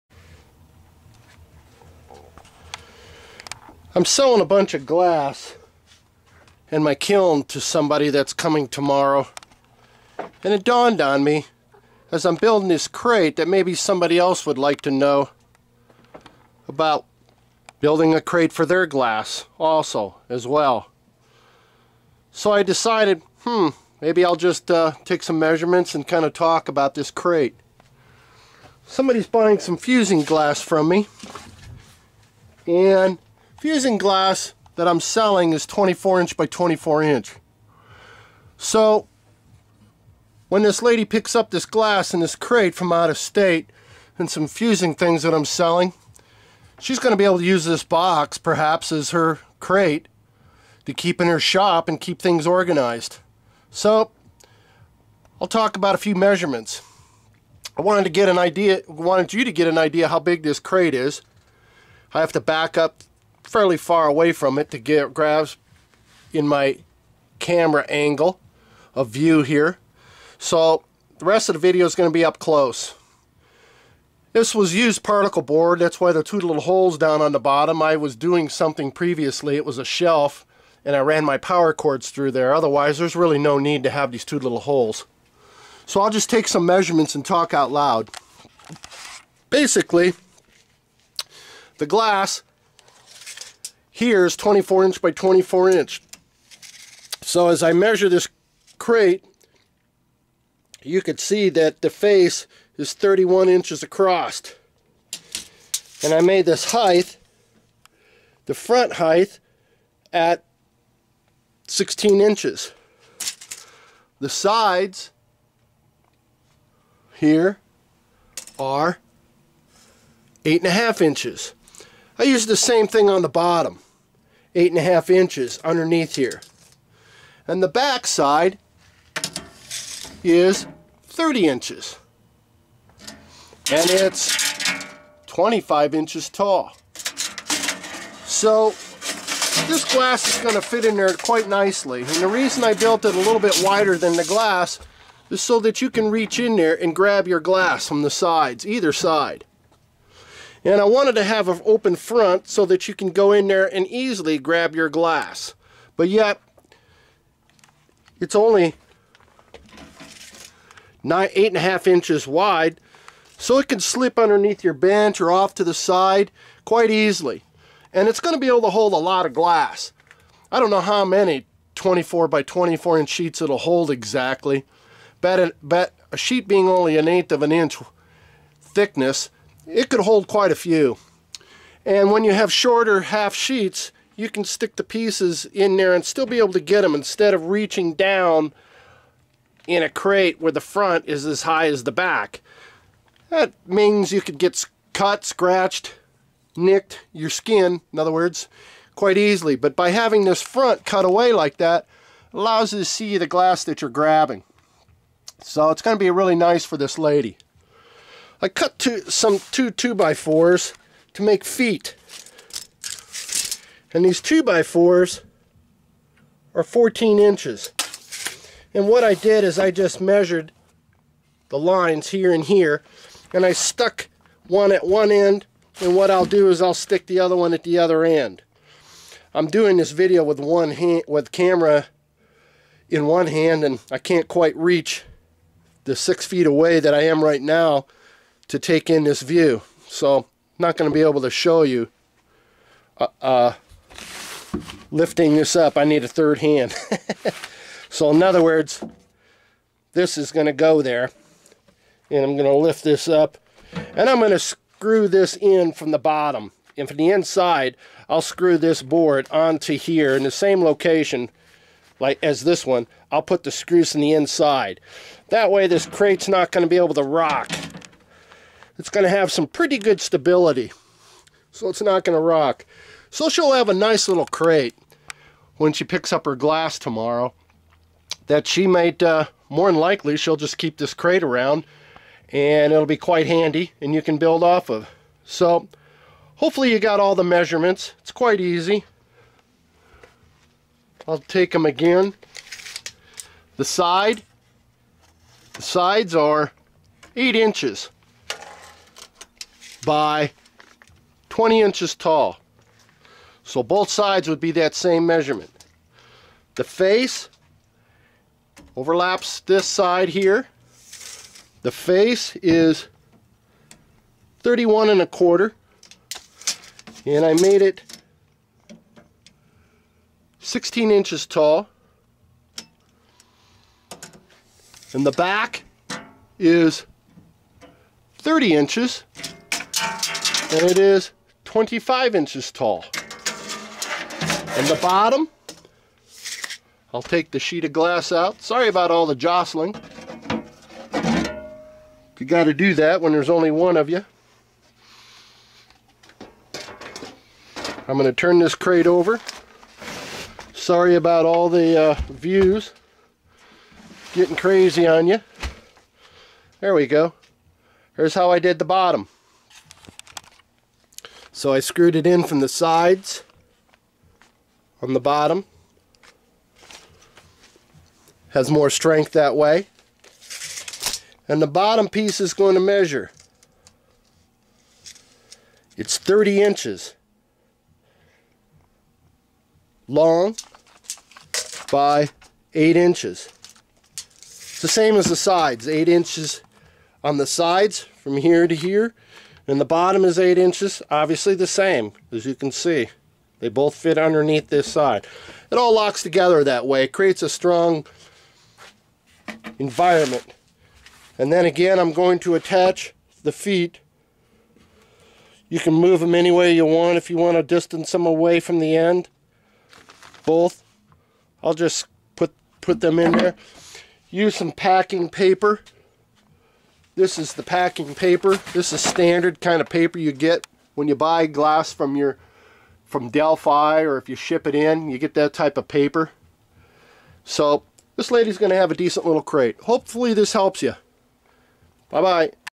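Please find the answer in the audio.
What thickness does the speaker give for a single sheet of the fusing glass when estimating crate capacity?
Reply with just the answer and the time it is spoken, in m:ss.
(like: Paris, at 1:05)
An eighth of an inch, at 2:56.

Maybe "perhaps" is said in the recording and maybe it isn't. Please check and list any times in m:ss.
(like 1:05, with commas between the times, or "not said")
0:48.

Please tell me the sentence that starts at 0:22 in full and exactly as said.
So I decided, hmm, maybe I'll just uh, take some measurements and kind of talk about this crate.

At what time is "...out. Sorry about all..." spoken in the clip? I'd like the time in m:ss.
5:38.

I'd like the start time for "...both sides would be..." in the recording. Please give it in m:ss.
5:03.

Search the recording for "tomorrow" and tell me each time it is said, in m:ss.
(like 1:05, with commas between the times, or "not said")
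0:08, 4:36.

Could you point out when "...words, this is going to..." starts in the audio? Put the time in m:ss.
4:08.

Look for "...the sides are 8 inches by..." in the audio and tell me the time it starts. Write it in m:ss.
4:55.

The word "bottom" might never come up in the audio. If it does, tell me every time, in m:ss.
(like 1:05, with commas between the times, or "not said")
1:17, 2:03, 4:15, 5:34, 5:58, 6:04, 6:11, 6:29.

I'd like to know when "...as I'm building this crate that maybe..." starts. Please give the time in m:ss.
0:12.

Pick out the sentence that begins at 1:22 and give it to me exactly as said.
Otherwise, there's really no need to have these two little holes.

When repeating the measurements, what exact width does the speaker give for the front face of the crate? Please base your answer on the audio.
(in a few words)
31 1/4 inches.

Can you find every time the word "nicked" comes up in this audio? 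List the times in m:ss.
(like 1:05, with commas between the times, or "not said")
3:16.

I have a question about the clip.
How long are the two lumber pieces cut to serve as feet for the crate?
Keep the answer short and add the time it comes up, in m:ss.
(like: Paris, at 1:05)
14 inches, at 3:36.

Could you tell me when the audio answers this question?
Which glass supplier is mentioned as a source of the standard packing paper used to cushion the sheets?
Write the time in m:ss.
7:03.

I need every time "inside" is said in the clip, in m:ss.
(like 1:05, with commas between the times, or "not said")
4:17, 4:24.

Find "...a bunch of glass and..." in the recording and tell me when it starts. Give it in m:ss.
0:04.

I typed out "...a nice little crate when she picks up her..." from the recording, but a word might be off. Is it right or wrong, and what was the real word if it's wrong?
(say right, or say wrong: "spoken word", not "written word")
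right.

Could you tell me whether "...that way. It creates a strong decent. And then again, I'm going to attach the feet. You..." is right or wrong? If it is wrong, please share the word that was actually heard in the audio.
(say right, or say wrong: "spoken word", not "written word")
wrong: "environment", not "decent".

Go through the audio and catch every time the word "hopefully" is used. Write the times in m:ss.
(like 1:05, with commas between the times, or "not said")
4:46, 7:09.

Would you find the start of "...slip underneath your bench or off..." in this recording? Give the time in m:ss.
2:43.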